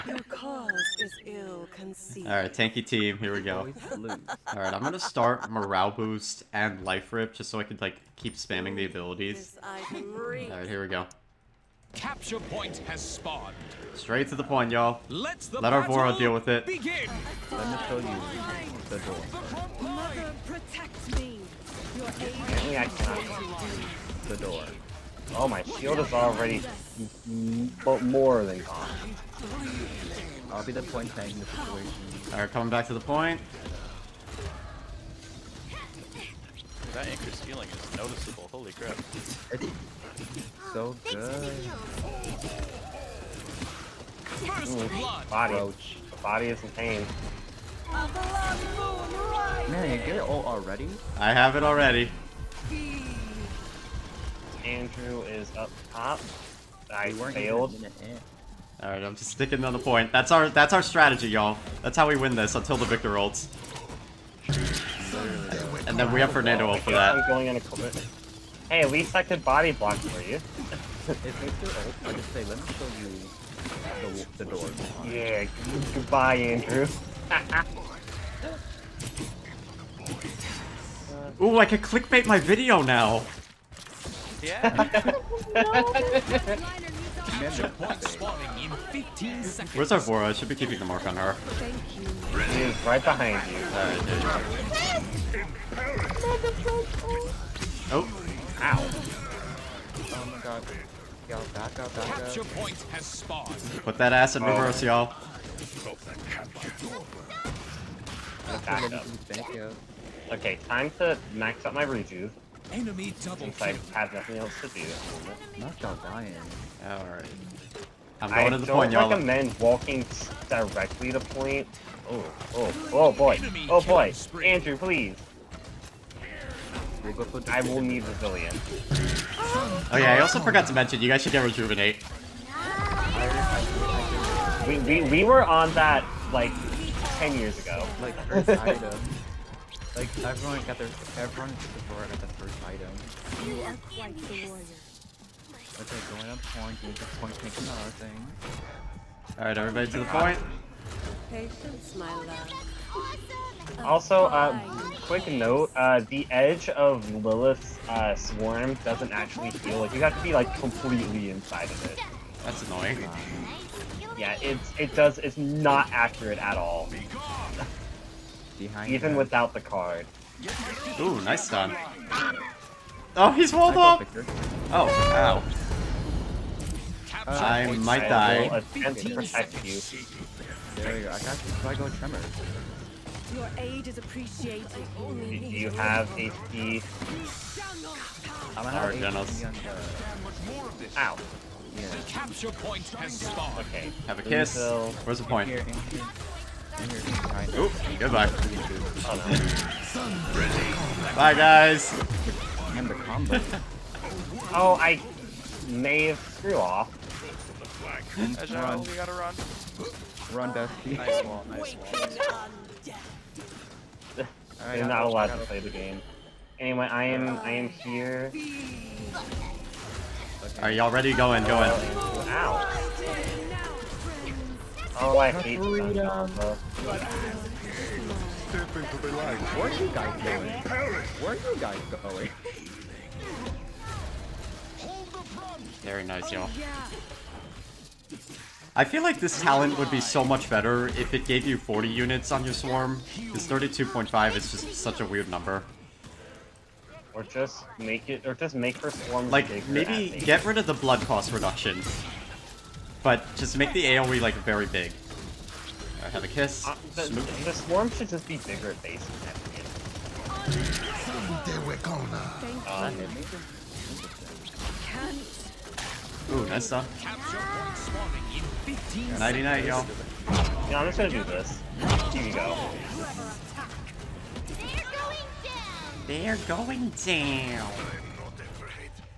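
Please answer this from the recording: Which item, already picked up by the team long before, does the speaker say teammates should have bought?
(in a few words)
Rejuvenate.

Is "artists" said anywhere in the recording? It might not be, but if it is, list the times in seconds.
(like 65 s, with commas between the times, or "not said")
not said.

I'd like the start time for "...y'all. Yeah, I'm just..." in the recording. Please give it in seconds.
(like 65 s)
269 s.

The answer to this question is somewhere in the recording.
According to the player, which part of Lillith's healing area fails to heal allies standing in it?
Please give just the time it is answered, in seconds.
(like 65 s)
156 s.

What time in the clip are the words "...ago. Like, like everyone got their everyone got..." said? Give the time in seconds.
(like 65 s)
137 s.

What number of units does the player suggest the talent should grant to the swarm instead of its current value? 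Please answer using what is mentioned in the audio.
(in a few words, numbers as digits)
40.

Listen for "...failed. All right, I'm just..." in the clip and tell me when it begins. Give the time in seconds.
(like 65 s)
57 s.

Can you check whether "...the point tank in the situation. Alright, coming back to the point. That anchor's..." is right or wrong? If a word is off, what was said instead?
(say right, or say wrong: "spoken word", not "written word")
right.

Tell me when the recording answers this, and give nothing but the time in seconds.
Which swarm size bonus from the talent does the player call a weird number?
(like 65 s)
243 s.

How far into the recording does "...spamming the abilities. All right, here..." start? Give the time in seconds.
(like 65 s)
8 s.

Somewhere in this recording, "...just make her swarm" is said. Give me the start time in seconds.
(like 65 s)
248 s.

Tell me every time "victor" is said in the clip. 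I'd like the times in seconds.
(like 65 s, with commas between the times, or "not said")
62 s, 71 s.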